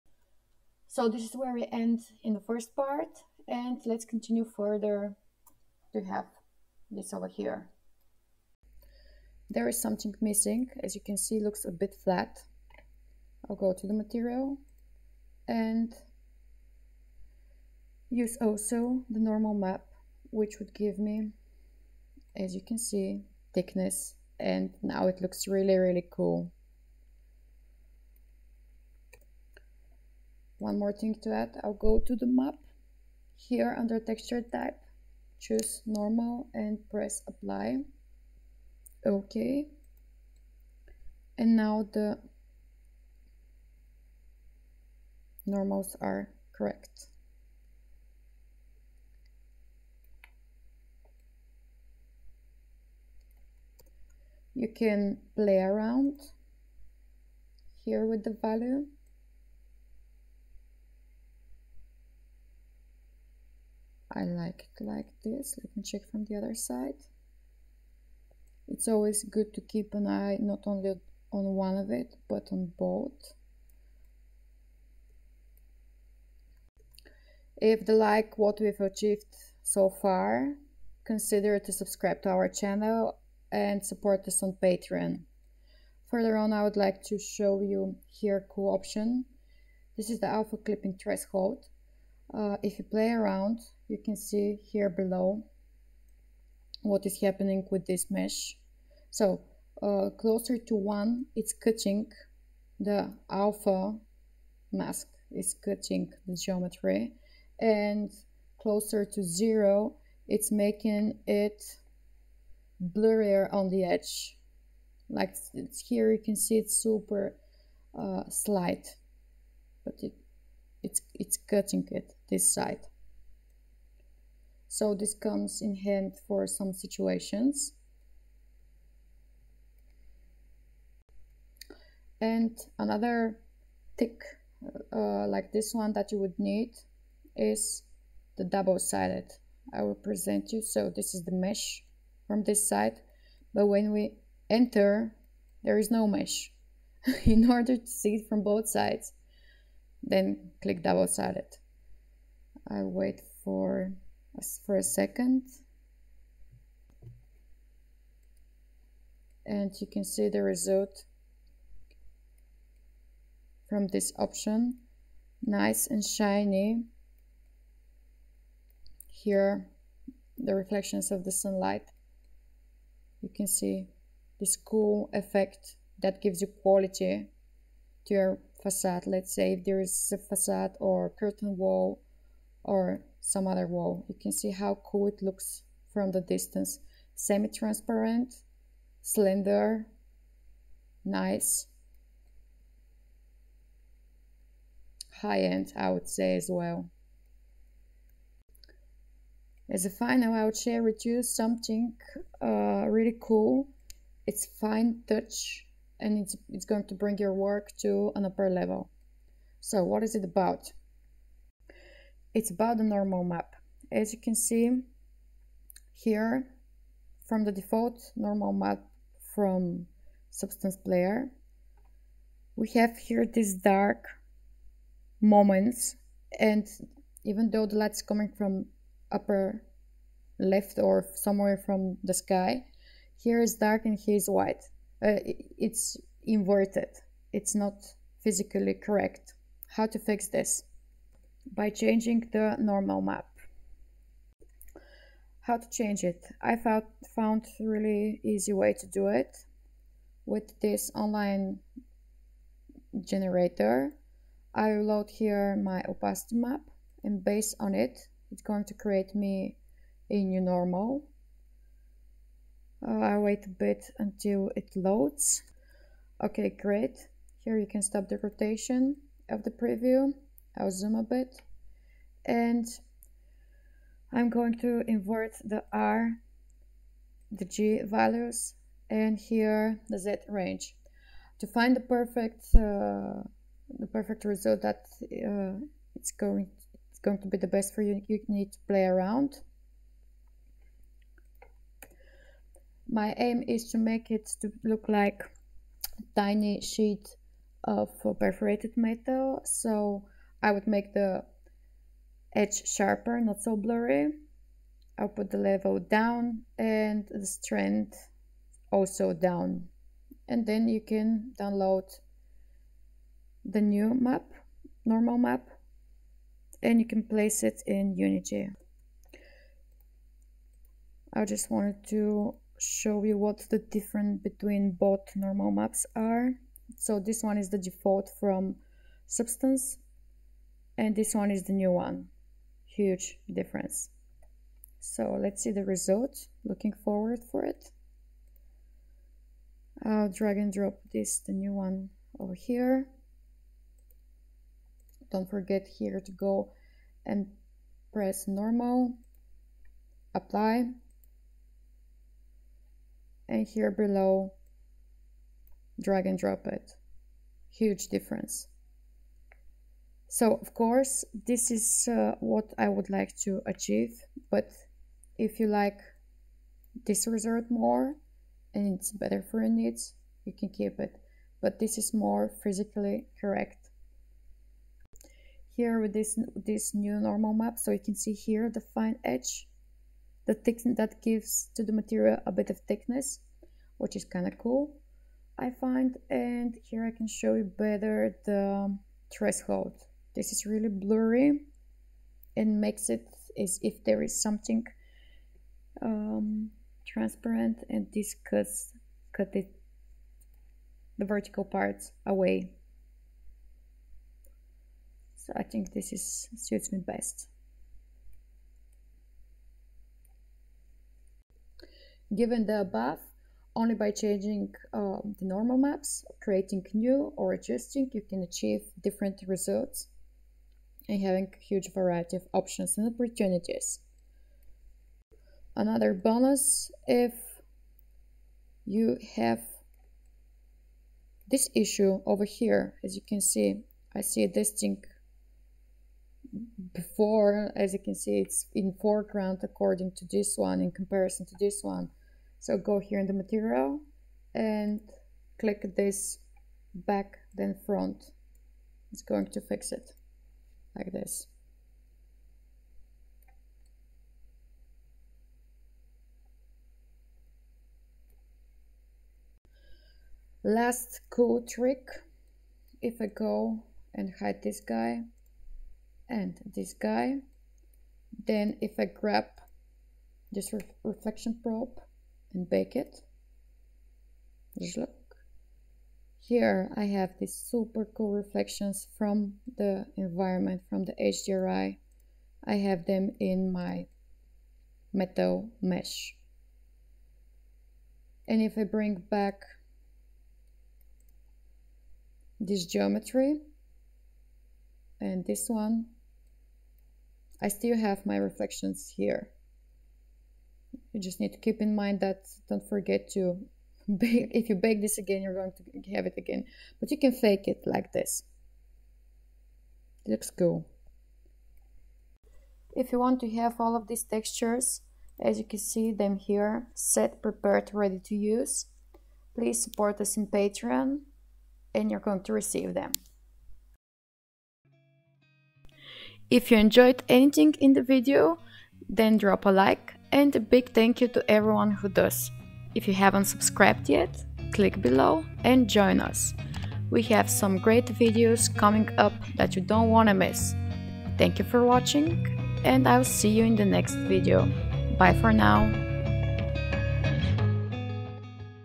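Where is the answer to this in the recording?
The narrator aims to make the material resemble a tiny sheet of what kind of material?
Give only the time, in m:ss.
4:58.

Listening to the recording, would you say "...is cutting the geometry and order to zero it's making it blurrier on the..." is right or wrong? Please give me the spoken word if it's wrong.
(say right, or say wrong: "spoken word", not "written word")
wrong: "closer", not "order".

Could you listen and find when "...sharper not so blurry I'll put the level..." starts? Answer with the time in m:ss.
5:02.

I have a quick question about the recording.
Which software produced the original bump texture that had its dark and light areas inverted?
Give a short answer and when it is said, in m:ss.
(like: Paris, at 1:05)
Substance Player, at 3:40.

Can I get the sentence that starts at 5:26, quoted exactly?
So this one is the default from substance and this one is the new one.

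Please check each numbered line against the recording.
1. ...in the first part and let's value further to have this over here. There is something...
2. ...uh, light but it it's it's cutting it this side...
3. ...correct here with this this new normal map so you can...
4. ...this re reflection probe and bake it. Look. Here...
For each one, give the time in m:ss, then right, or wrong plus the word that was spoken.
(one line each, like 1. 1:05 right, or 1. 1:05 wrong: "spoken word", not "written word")
1. 0:02 wrong: "continue", not "value"
2. 1:57 wrong: "slight", not "light"
3. 6:13 right
4. 7:50 right.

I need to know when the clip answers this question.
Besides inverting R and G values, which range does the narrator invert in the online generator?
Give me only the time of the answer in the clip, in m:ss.
4:39.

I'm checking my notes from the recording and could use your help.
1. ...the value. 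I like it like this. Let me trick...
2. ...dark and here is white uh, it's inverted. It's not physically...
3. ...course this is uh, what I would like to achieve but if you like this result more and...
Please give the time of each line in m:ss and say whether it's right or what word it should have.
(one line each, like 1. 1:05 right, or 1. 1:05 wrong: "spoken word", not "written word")
1. 0:58 wrong: "check", not "trick"
2. 3:53 right
3. 6:00 right.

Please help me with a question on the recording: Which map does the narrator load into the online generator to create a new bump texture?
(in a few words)
Opacity map.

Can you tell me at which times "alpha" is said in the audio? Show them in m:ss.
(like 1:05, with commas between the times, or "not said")
1:30, 1:43.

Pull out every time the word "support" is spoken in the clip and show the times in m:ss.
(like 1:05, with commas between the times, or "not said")
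1:23, 8:39.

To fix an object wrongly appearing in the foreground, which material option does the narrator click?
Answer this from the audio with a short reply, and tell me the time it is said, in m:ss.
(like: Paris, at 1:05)
Back then front, at 7:26.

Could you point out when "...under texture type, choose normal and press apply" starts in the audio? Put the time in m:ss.
0:33.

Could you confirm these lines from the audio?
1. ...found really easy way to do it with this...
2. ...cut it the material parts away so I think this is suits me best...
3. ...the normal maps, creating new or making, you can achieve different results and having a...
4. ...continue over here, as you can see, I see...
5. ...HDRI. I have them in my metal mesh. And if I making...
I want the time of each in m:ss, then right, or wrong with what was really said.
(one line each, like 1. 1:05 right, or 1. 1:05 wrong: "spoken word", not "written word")
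1. 4:07 right
2. 6:39 wrong: "vertical", not "material"
3. 6:55 wrong: "adjusting", not "making"
4. 7:11 wrong: "issue", not "continue"
5. 8:00 wrong: "bring", not "making".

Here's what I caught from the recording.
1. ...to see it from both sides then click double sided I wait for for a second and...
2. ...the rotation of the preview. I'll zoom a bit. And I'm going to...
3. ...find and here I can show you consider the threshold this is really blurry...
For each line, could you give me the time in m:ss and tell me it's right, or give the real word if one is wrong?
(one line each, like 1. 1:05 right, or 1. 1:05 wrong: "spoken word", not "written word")
1. 2:27 right
2. 4:28 right
3. 6:25 wrong: "better", not "consider".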